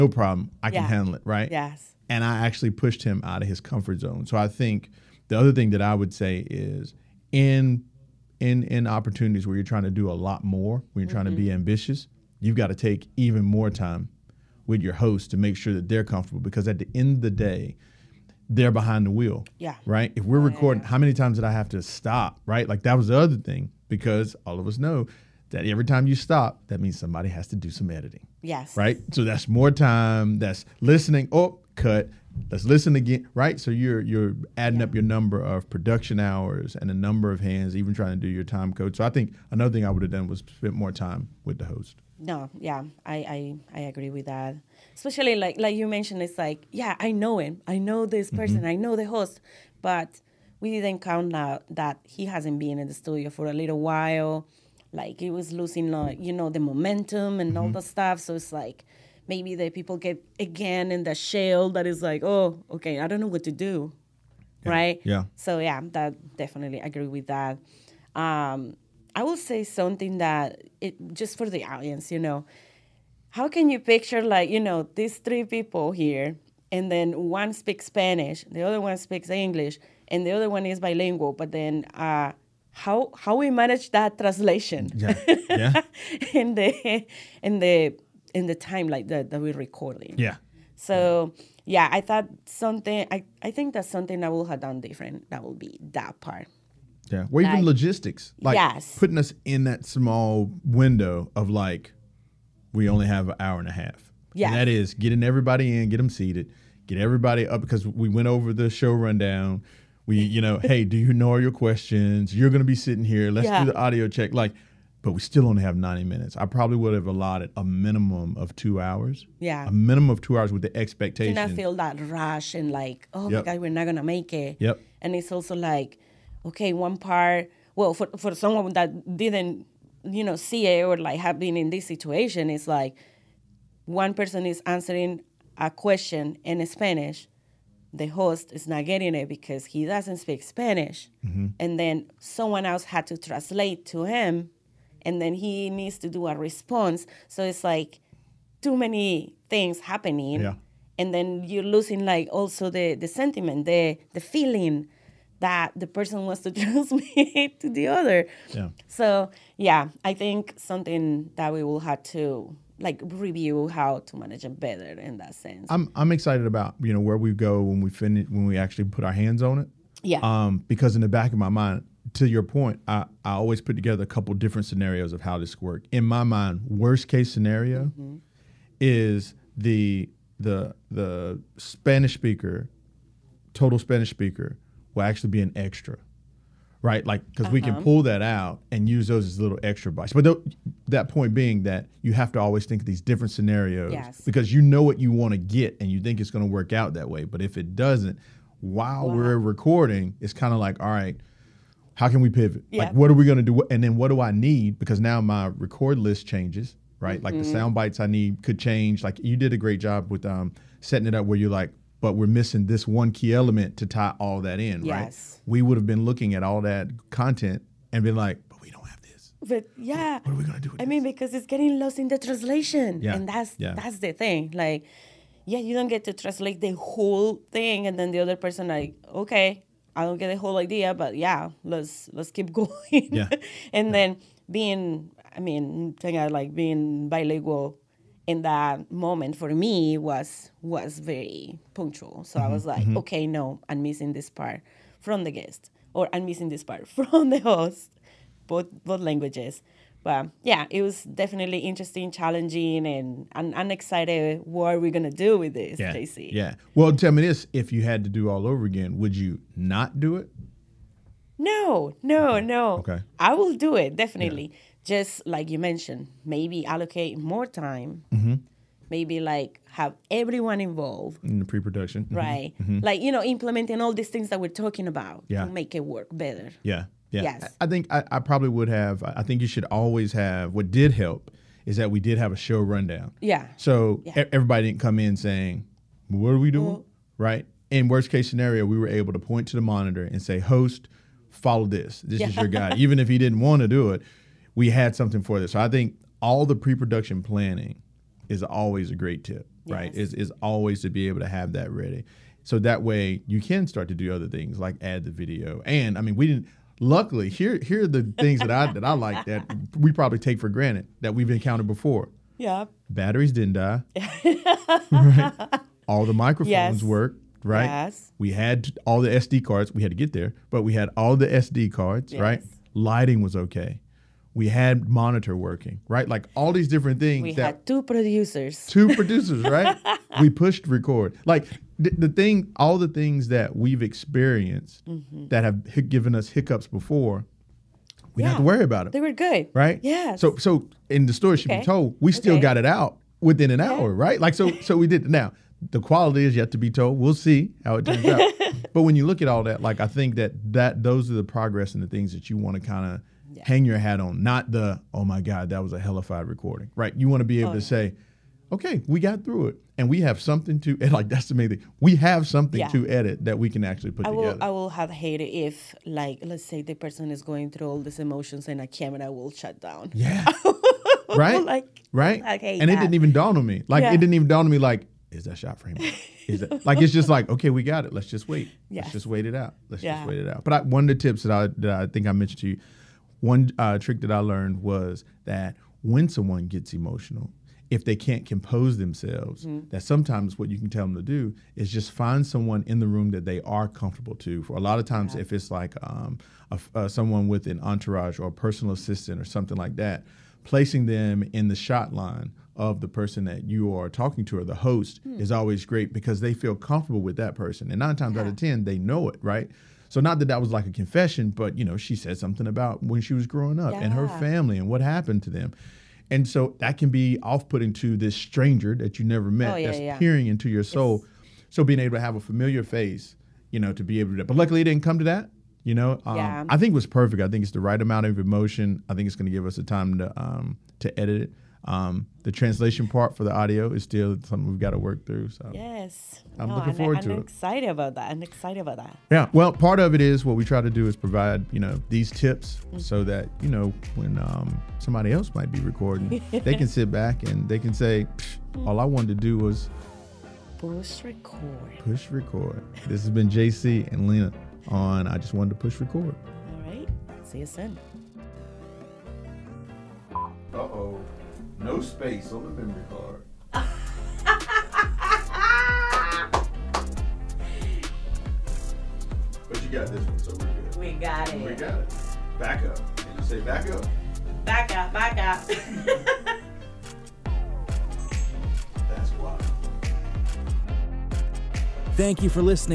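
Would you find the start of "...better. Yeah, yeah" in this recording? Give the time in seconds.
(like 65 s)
276 s.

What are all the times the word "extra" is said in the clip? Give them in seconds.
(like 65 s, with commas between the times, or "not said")
185 s, 189 s.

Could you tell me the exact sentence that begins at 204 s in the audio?
Because now my record list changes, right?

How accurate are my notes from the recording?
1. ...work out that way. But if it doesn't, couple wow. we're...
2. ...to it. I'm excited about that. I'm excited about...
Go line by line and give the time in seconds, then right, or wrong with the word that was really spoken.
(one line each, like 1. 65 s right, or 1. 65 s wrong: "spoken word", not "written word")
1. 196 s wrong: "while", not "couple"
2. 437 s right.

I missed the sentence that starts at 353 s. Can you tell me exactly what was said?
hang your hat on, not the, oh my God, that was a hellified recording, right?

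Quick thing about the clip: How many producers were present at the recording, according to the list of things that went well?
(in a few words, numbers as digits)
2.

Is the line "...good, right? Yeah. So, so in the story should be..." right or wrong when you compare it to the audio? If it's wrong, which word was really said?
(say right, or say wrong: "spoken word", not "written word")
right.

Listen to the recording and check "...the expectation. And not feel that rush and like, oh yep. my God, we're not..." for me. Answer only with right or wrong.
right.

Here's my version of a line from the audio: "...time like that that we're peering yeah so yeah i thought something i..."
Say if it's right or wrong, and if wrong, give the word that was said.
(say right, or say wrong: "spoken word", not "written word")
wrong: "recording", not "peering".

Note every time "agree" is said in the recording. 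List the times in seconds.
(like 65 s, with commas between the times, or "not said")
43 s, 66 s.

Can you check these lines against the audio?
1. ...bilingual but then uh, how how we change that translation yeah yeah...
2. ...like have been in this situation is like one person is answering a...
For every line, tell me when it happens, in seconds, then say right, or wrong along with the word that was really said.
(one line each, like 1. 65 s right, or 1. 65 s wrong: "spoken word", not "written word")
1. 80 s wrong: "manage", not "change"
2. 130 s right.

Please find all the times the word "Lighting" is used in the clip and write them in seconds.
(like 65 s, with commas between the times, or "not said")
322 s.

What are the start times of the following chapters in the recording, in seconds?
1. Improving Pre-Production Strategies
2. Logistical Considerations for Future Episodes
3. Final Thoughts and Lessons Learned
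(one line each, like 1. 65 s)
1. 17 s
2. 158 s
3. 276 s.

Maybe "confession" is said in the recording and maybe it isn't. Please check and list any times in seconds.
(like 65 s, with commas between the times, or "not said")
410 s.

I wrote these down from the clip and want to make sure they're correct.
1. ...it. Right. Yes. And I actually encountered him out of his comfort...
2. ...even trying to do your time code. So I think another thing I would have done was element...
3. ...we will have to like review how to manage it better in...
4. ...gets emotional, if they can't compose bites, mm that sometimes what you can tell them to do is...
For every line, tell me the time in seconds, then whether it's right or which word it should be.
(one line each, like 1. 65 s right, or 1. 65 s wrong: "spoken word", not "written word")
1. 1 s wrong: "pushed", not "encountered"
2. 37 s wrong: "spent", not "element"
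3. 161 s right
4. 386 s wrong: "themselves", not "bites".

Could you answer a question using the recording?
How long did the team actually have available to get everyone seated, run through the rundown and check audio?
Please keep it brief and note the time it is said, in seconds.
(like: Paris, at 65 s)
An hour and a half, at 103 s.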